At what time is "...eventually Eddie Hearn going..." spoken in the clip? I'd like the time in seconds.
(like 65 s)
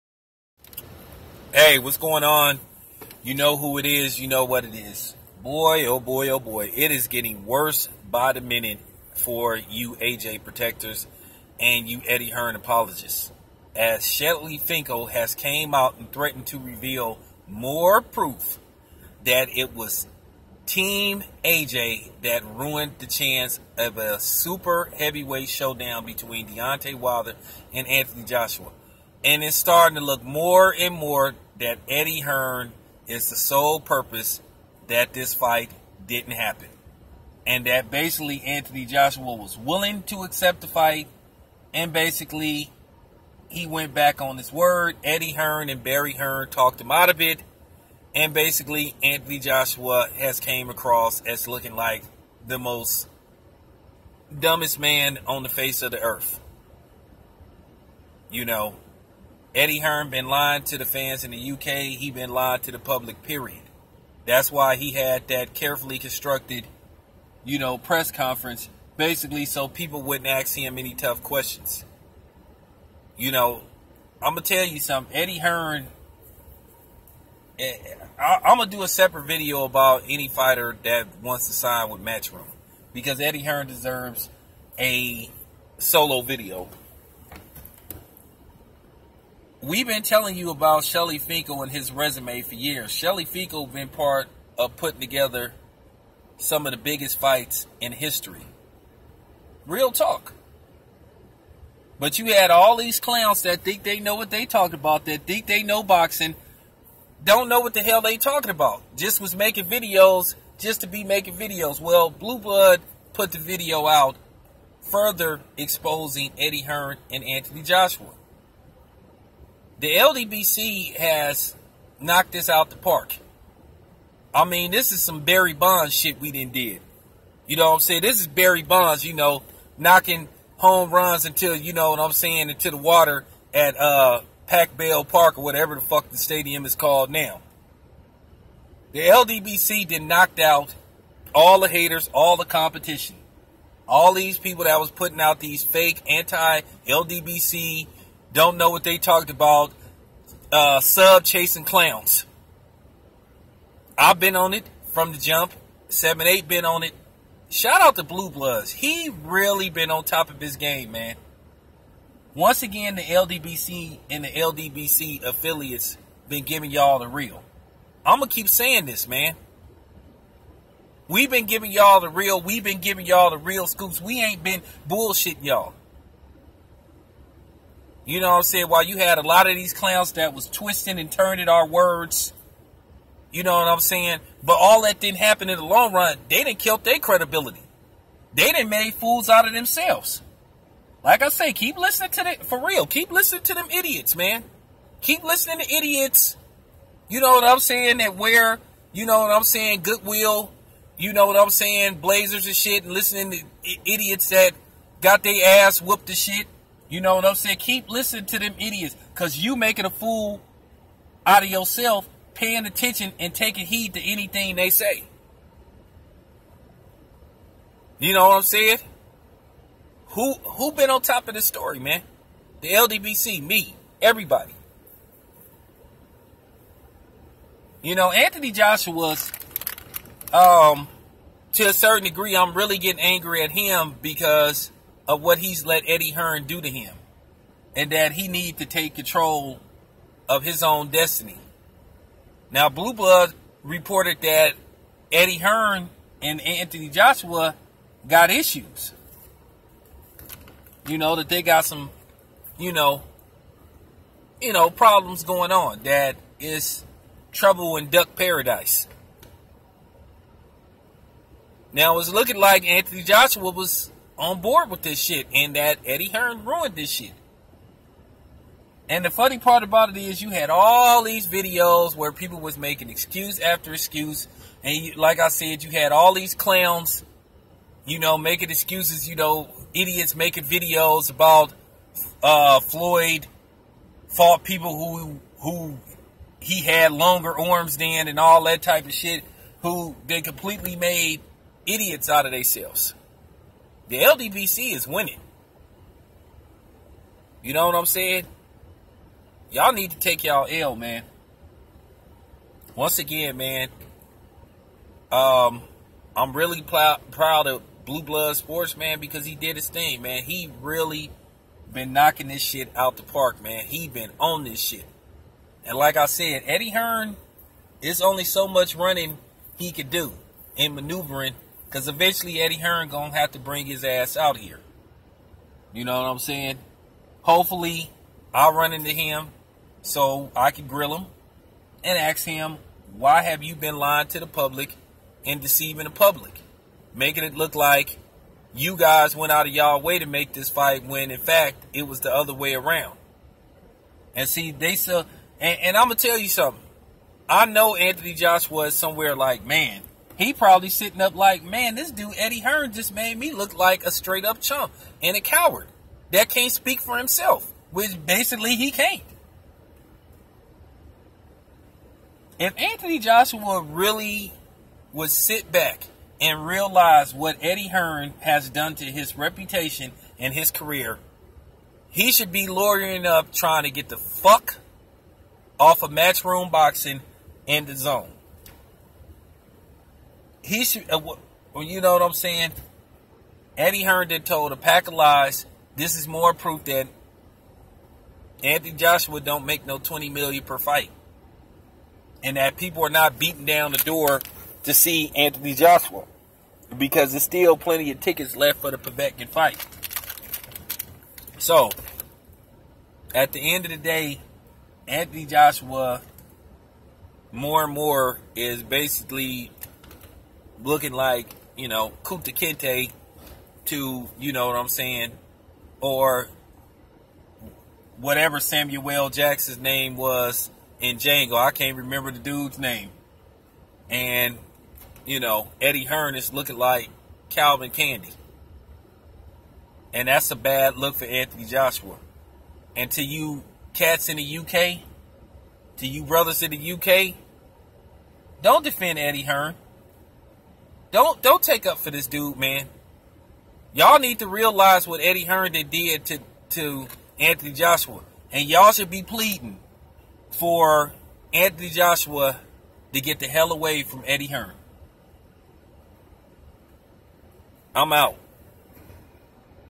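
321 s.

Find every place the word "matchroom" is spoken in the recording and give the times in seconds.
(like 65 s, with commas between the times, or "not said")
82 s, 375 s.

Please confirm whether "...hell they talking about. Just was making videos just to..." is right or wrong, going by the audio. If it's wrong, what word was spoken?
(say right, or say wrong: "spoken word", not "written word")
right.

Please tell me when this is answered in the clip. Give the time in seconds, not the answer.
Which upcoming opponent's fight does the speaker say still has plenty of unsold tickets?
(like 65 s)
398 s.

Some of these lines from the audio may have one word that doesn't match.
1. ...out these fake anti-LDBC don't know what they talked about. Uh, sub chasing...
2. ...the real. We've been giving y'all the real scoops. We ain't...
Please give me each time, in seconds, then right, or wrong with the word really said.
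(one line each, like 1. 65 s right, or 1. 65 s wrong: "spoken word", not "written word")
1. 145 s right
2. 171 s right.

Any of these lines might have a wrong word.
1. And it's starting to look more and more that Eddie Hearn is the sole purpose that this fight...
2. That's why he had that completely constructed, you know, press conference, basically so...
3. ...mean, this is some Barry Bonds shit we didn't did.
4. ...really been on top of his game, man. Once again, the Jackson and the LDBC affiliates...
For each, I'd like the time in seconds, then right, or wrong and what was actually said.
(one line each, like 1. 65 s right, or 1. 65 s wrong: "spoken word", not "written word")
1. 29 s right
2. 64 s wrong: "carefully", not "completely"
3. 124 s right
4. 159 s wrong: "LDBC", not "Jackson".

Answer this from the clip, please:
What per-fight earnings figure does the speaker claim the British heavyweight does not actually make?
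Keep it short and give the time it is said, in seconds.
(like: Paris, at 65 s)
20 million, at 389 s.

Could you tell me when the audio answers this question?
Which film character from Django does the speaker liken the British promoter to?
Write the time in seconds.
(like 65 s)
427 s.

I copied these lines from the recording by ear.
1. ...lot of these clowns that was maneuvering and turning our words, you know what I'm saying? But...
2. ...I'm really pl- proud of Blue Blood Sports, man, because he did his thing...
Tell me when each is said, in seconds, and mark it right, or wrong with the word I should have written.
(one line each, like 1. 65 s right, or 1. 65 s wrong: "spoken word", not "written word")
1. 179 s wrong: "twisting", not "maneuvering"
2. 306 s right.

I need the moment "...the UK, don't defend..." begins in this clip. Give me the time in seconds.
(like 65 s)
436 s.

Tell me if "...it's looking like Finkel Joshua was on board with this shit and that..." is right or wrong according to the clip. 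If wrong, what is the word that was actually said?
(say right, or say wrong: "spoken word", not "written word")
wrong: "Anthony", not "Finkel".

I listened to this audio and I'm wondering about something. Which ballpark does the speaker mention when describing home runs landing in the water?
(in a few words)
Pac Bell Park.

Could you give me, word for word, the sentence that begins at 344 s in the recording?
And see, they still, and, and I'm going to tell you something.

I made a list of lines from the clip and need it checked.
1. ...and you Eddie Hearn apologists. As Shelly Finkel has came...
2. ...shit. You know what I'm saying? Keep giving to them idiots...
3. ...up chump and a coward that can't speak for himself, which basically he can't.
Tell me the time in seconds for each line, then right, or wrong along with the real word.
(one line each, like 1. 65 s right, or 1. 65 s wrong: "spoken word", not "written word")
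1. 11 s right
2. 206 s wrong: "listening", not "giving"
3. 354 s right.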